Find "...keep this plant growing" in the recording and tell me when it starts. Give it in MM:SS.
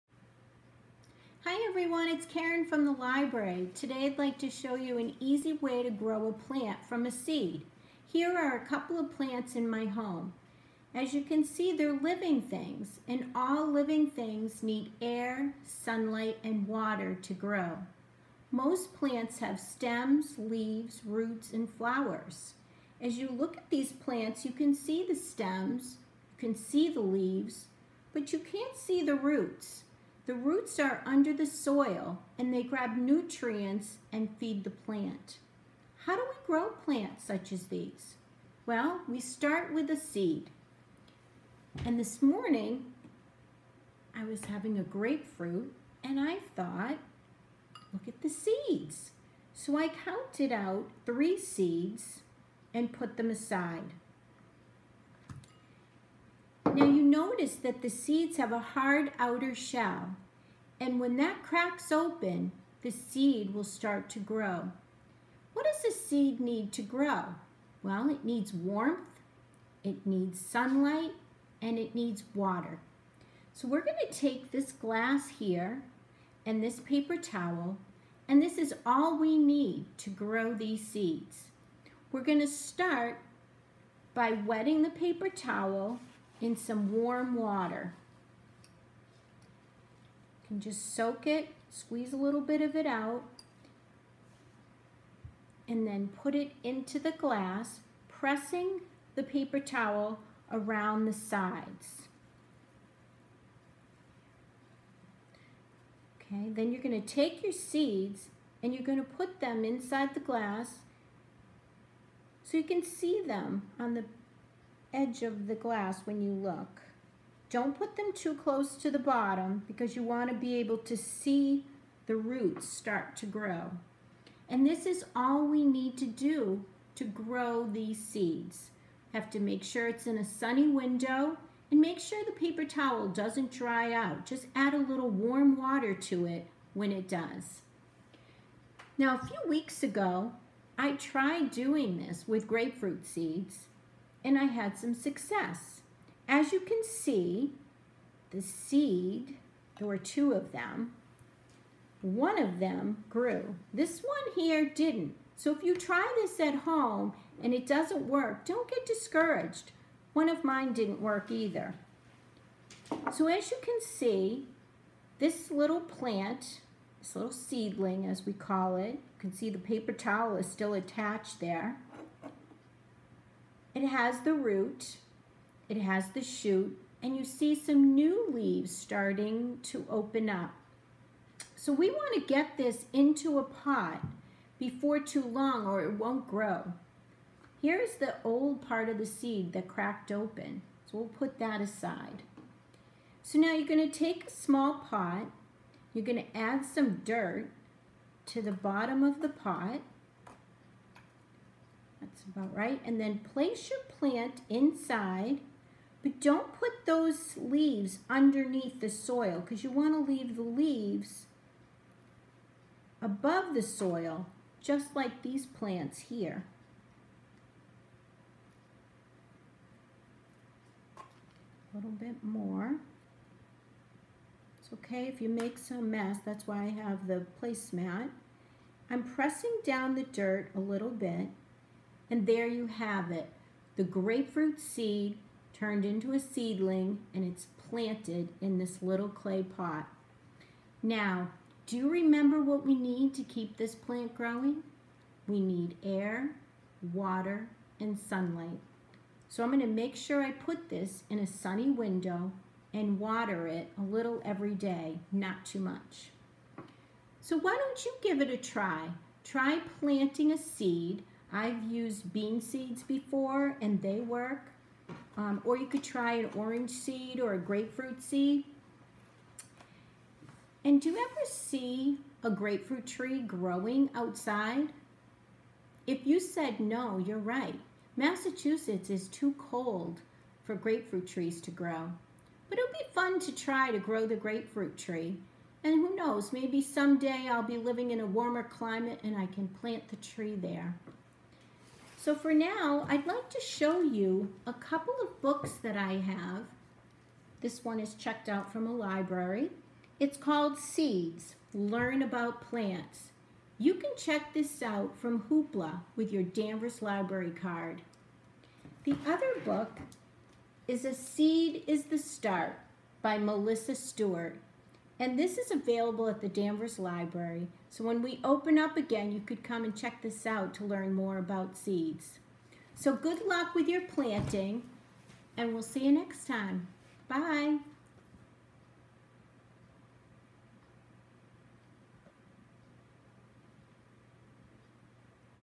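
04:03.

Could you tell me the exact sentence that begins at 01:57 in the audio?
Don't put them too close to the bottom because you want to be able to see the roots start to grow.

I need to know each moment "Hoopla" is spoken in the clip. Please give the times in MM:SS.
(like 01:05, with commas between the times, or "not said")
05:05.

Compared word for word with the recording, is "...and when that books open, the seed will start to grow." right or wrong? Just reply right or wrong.
wrong.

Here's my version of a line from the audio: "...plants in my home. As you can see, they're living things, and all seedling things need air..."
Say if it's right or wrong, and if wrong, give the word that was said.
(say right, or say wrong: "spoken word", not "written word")
wrong: "living", not "seedling".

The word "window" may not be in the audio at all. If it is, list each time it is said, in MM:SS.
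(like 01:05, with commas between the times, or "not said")
02:10, 04:11.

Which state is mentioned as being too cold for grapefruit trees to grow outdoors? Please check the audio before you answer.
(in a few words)
Massachusetts.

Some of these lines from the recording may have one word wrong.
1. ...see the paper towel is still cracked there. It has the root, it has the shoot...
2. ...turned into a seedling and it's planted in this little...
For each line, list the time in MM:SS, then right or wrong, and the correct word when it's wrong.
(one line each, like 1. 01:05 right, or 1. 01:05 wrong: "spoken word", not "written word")
1. 02:49 wrong: "attached", not "cracked"
2. 03:55 right.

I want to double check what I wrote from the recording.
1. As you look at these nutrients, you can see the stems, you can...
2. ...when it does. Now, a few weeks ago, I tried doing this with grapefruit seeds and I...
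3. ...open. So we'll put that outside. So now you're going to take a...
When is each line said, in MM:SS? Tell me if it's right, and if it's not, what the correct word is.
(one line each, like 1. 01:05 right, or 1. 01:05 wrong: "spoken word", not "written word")
1. 00:22 wrong: "plants", not "nutrients"
2. 02:16 right
3. 03:10 wrong: "aside", not "outside".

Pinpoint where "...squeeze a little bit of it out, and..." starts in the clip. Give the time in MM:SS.
01:31.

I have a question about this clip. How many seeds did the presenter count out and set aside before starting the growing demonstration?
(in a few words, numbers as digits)
3.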